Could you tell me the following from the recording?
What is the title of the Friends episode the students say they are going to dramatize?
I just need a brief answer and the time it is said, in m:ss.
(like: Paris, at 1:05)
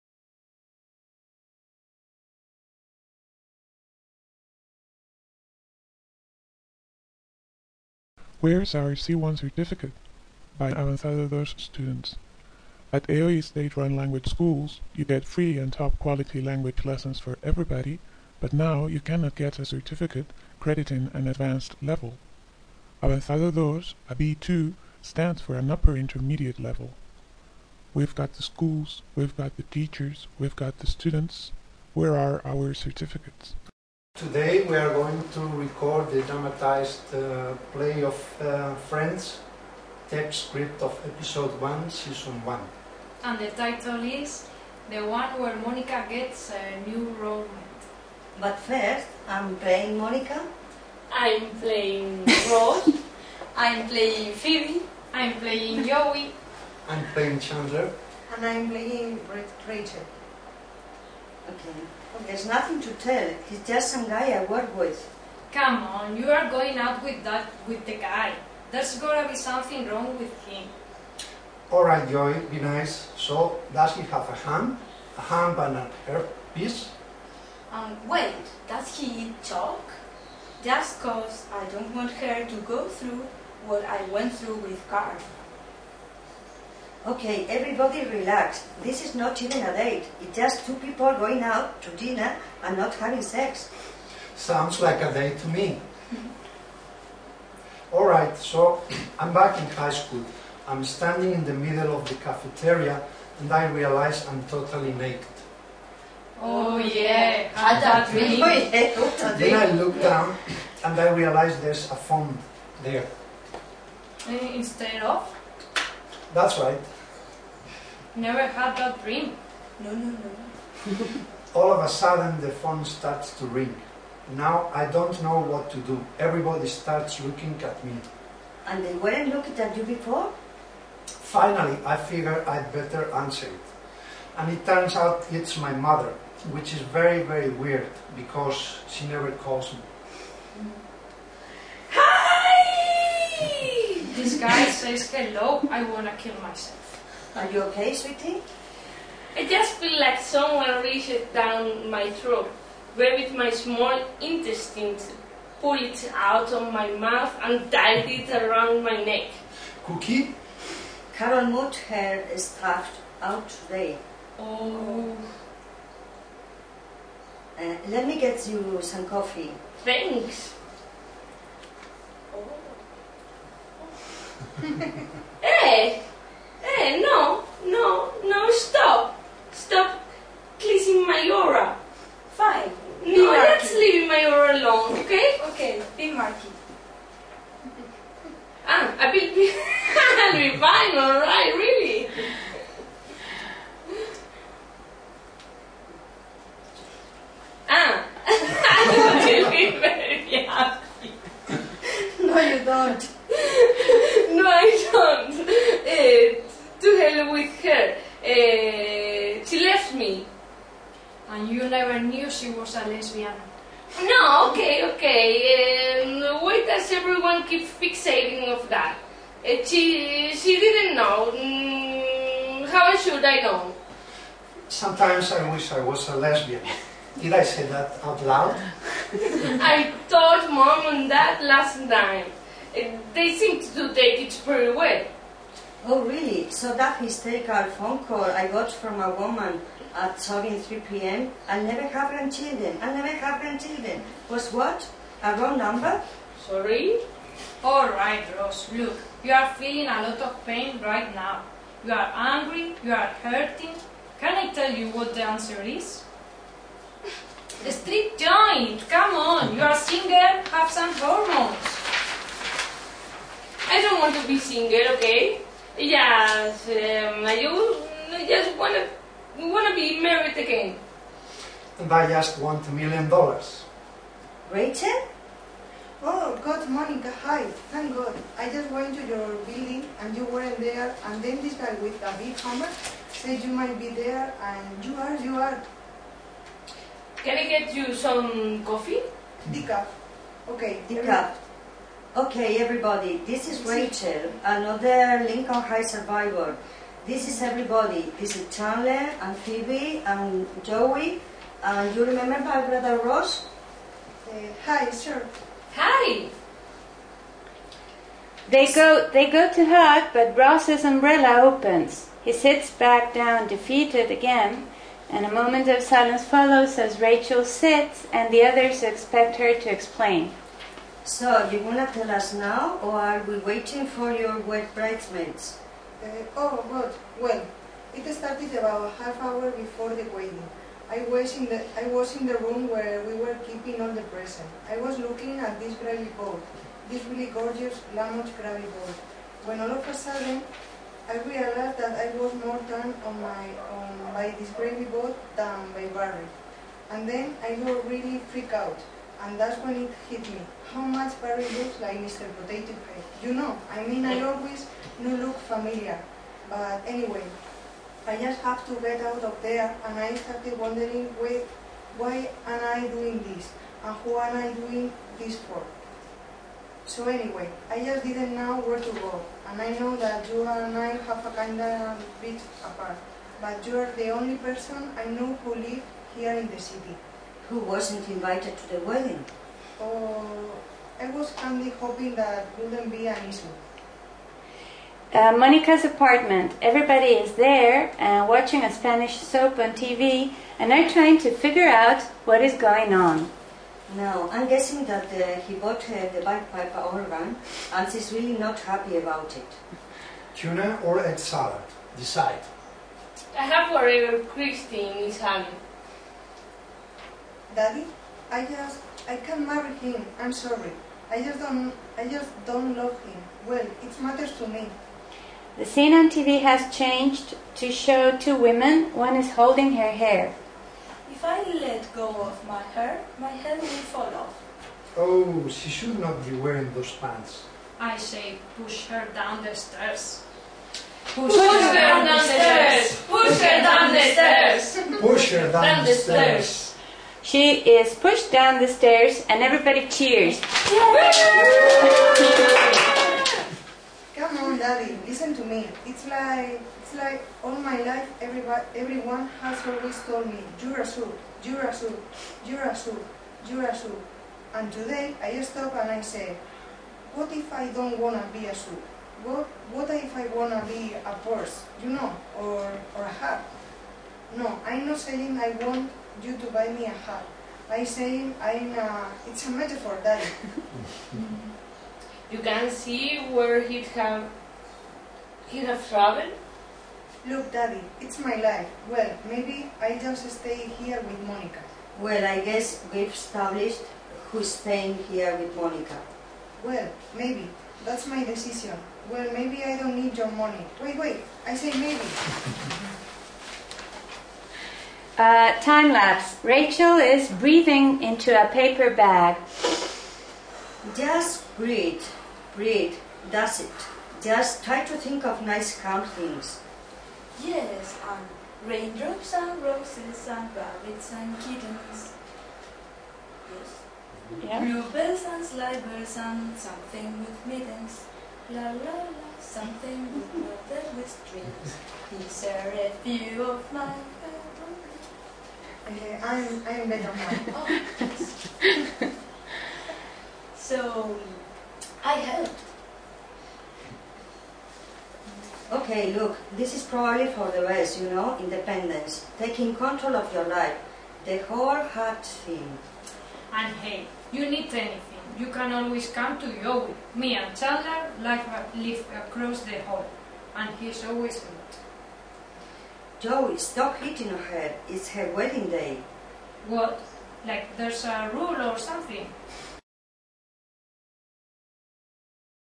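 The One Where Monica Gets a New Roommate, at 0:44.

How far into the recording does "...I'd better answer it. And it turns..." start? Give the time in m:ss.
2:12.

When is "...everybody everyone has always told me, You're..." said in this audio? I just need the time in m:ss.
7:28.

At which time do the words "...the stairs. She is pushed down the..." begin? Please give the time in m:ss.
7:15.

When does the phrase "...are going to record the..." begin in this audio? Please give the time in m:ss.
0:34.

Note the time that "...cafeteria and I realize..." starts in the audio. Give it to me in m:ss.
1:42.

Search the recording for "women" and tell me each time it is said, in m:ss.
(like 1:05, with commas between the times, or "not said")
6:58.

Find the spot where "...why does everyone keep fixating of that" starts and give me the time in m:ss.
3:36.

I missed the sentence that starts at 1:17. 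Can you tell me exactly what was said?
Um, wait, does he eat chalk?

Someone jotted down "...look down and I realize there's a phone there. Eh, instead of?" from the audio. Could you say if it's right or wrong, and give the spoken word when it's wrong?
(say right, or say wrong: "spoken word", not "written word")
right.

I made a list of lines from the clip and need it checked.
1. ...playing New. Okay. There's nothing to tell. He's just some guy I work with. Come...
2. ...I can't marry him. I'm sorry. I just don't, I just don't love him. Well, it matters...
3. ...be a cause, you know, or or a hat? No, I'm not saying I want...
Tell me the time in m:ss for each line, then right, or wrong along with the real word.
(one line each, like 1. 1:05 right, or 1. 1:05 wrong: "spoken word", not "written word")
1. 0:58 wrong: "Rachel", not "New"
2. 6:49 right
3. 7:40 wrong: "horse", not "cause".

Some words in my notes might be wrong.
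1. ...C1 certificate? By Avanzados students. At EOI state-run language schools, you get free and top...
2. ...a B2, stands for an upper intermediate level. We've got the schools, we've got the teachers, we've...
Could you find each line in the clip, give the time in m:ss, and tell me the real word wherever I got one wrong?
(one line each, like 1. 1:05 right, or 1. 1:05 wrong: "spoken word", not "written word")
1. 0:08 right
2. 0:24 right.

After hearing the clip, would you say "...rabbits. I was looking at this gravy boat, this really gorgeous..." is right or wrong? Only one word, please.
wrong.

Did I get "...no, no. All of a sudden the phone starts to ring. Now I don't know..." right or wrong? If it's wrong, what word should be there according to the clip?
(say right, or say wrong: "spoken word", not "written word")
right.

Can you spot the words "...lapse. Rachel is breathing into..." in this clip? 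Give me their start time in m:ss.
8:15.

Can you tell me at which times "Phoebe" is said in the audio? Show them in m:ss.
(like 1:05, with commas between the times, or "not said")
0:54, 4:59.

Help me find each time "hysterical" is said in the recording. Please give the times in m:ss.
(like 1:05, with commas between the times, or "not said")
3:57.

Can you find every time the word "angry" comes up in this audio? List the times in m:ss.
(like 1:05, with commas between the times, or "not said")
4:12.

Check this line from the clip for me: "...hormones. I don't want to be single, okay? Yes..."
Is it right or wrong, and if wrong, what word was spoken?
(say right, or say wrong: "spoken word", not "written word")
right.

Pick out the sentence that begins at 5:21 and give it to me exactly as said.
So, you're gonna tell us now, or are we waiting for your wet bridesmaids?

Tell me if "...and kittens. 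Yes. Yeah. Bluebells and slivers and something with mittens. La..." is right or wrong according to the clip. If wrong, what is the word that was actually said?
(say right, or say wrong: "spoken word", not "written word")
right.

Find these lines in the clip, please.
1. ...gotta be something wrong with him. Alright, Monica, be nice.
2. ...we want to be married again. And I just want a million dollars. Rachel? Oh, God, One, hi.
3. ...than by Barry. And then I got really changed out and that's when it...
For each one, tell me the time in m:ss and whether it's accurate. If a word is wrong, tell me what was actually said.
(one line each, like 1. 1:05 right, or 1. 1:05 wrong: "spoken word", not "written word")
1. 1:08 wrong: "Joey", not "Monica"
2. 4:29 wrong: "Monica", not "One"
3. 5:45 wrong: "freaked", not "changed".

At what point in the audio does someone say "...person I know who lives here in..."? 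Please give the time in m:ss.
6:14.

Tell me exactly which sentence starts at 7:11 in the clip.
Push, push her, her down, the stairs.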